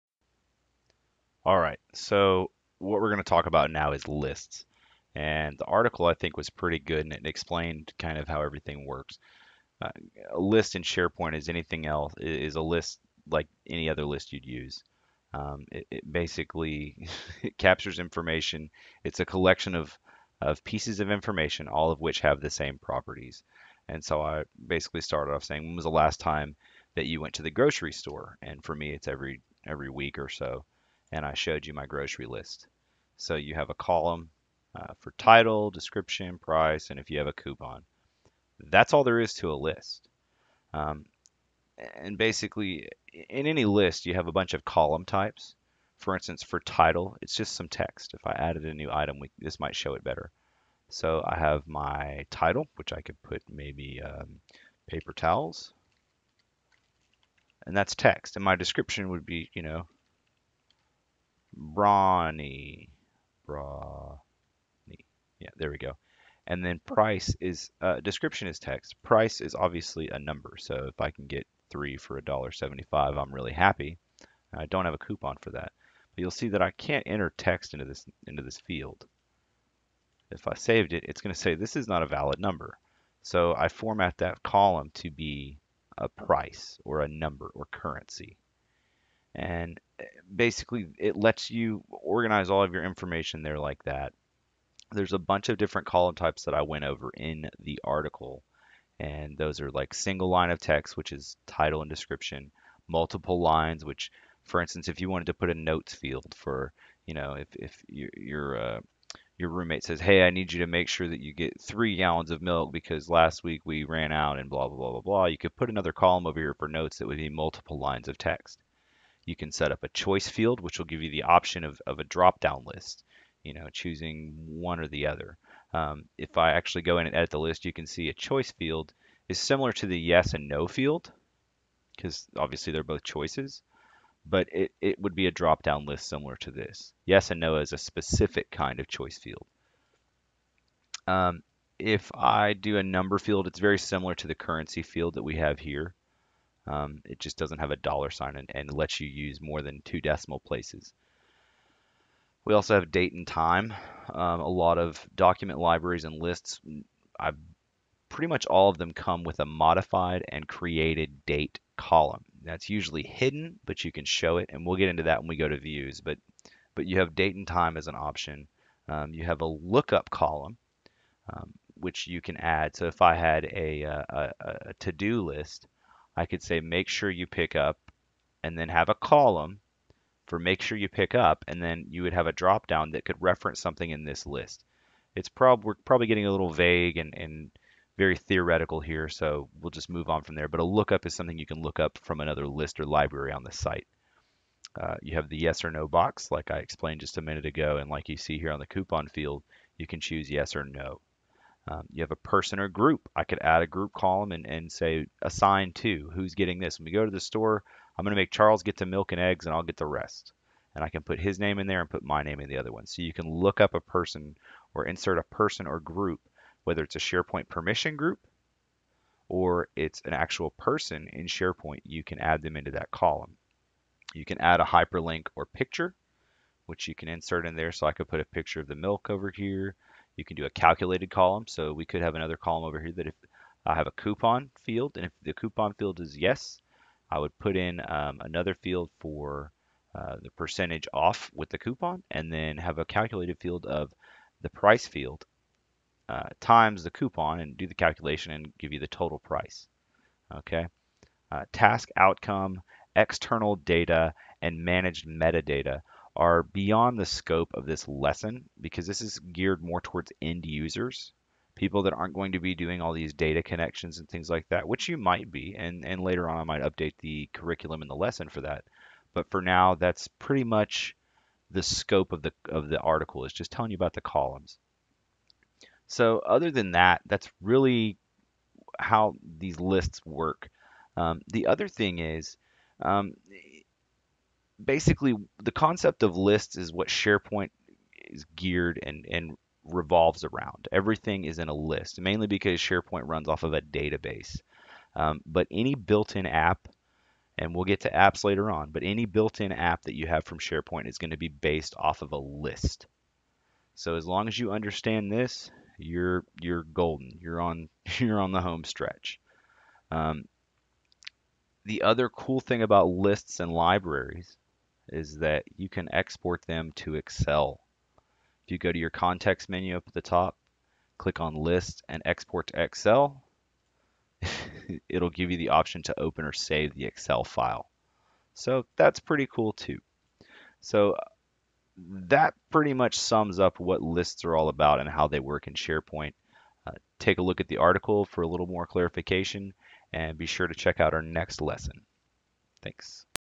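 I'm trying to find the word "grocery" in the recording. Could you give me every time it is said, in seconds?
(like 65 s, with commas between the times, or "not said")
27 s, 31 s.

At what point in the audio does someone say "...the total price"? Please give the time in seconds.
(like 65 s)
248 s.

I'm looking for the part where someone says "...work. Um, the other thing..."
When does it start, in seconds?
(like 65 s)
280 s.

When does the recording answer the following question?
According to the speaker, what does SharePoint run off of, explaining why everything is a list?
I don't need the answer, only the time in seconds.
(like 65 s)
293 s.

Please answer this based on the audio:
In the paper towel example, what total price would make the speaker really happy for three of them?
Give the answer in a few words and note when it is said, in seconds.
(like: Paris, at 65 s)
$1.75, at 72 s.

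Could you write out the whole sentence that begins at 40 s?
Um, and basically, in any list, you have a bunch of column types.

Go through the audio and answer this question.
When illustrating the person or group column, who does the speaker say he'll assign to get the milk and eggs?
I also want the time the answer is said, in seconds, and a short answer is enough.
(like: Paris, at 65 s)
Charles, at 208 s.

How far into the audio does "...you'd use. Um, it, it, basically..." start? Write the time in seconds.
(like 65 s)
14 s.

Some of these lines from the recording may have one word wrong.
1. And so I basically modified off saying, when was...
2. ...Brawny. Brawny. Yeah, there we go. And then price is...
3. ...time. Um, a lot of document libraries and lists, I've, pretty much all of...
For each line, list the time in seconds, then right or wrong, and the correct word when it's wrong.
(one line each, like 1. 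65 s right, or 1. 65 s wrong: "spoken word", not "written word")
1. 23 s wrong: "started", not "modified"
2. 61 s right
3. 153 s right.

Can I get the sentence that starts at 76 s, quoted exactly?
But you'll see that I can't enter text into this, into this field.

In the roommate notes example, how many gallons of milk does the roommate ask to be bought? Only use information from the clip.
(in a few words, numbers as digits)
3.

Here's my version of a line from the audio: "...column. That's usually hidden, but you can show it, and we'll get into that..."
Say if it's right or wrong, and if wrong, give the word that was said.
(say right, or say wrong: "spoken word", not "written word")
right.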